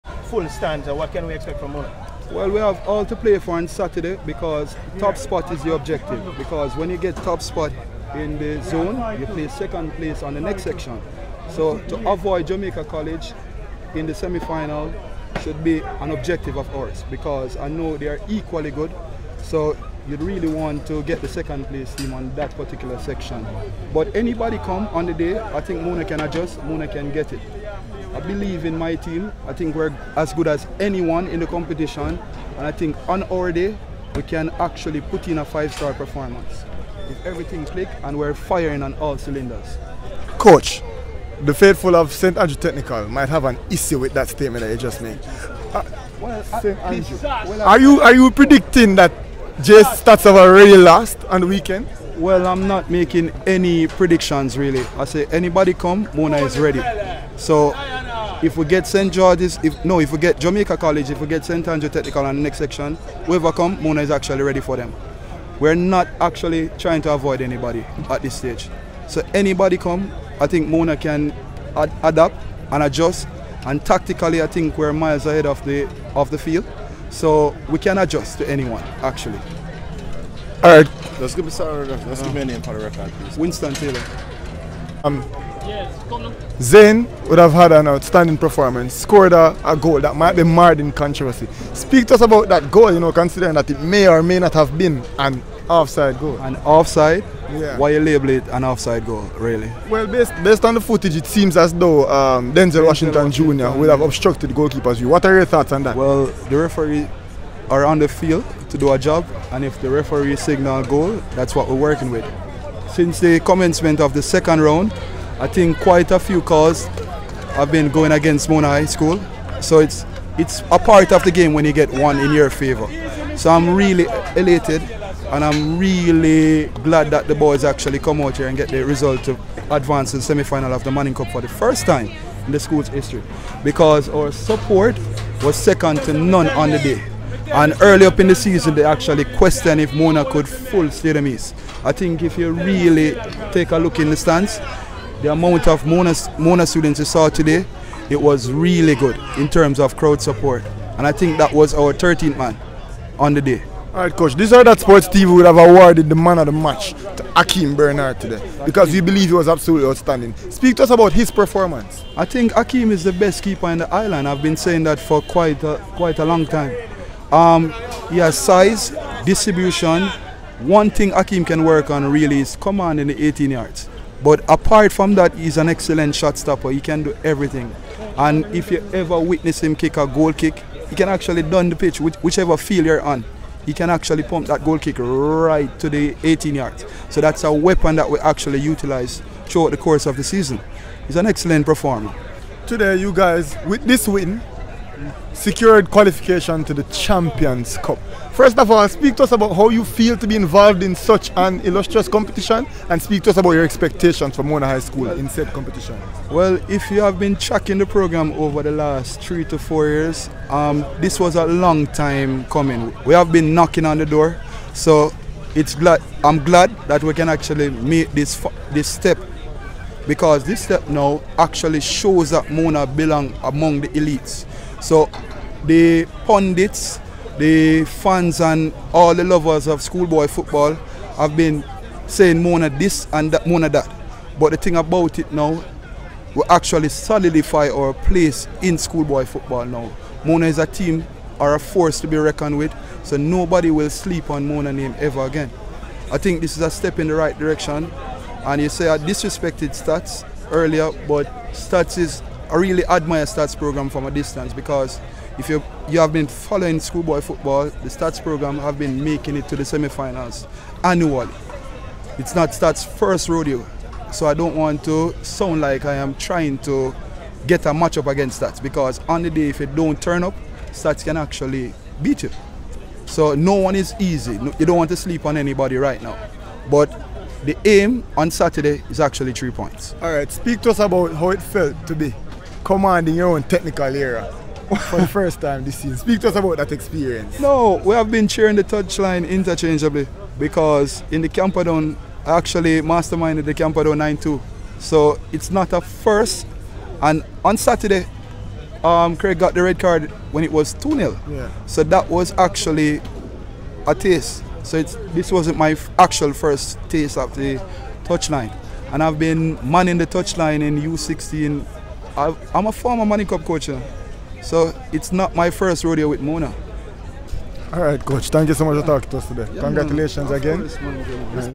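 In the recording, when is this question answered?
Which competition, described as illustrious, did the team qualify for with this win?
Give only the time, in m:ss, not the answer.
3:16.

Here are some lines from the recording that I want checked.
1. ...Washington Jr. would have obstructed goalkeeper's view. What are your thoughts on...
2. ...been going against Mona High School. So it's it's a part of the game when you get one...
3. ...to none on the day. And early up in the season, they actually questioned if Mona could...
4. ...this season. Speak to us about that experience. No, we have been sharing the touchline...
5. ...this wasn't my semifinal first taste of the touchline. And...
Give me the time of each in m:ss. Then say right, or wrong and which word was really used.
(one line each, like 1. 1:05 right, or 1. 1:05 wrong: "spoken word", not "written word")
1. 1:43 right
2. 1:57 right
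3. 2:16 right
4. 4:45 right
5. 5:04 wrong: "actual", not "semifinal".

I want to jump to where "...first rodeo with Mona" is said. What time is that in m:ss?
5:15.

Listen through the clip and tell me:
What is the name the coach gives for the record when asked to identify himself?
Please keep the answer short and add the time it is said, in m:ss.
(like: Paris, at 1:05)
Winston Taylor, at 1:23.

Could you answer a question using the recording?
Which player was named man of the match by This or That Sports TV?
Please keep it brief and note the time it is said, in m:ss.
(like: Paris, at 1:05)
Akim Bernard, at 2:37.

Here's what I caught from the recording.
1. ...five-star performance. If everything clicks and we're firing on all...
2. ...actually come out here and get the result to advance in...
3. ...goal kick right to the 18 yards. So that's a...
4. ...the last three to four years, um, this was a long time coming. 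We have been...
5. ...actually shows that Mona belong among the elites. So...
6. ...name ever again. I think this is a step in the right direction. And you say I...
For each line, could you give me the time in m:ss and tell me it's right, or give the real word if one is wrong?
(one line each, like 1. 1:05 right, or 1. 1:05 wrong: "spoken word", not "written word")
1. 0:35 right
2. 2:07 right
3. 3:04 right
4. 3:28 right
5. 3:41 right
6. 4:04 right.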